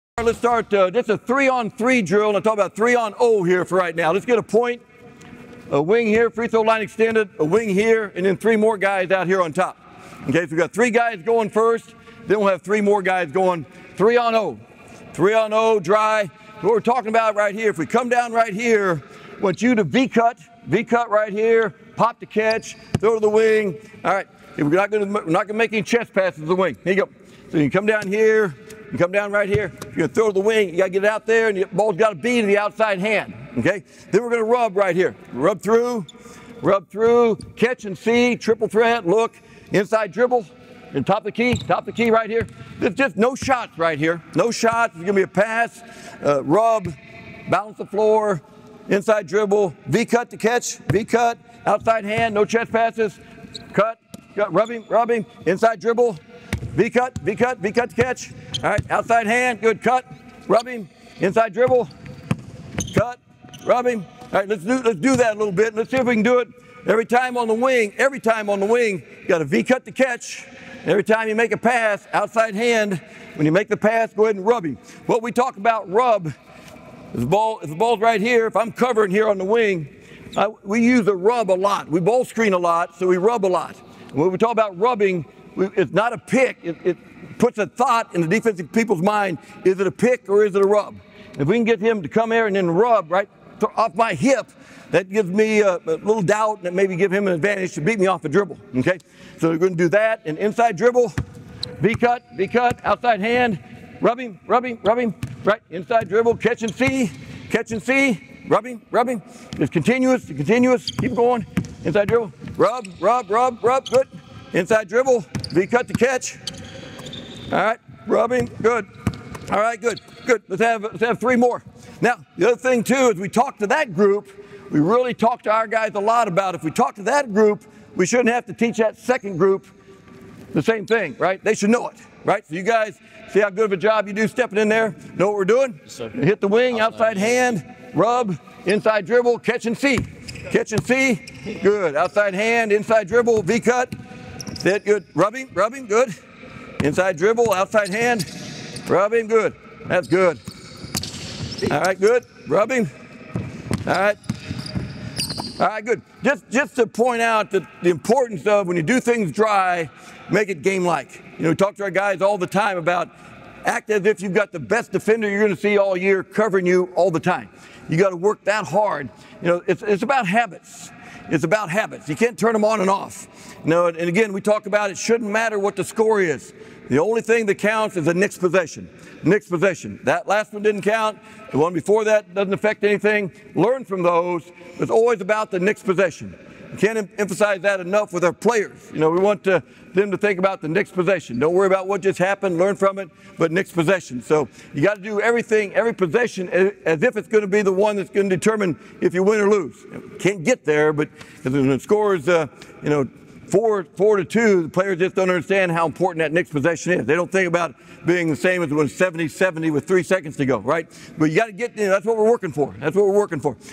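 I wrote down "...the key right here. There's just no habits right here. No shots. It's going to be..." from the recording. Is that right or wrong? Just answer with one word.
wrong.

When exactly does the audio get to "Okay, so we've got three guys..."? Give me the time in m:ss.
0:10.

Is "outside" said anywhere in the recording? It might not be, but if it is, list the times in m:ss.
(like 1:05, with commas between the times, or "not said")
0:32, 0:51, 0:58, 1:12, 1:42, 2:16, 2:21, 2:27.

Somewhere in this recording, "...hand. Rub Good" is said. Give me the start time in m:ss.
2:27.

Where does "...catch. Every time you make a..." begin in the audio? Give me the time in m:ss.
1:09.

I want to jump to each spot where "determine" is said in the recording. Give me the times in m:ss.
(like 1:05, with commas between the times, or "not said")
3:18.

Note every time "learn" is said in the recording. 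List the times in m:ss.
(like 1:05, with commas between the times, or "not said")
3:03, 3:12.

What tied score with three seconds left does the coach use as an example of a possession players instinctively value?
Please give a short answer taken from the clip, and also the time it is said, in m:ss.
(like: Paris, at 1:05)
70-70, at 3:28.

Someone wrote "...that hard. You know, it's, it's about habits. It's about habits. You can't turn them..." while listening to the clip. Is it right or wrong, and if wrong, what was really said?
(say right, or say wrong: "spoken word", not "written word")
right.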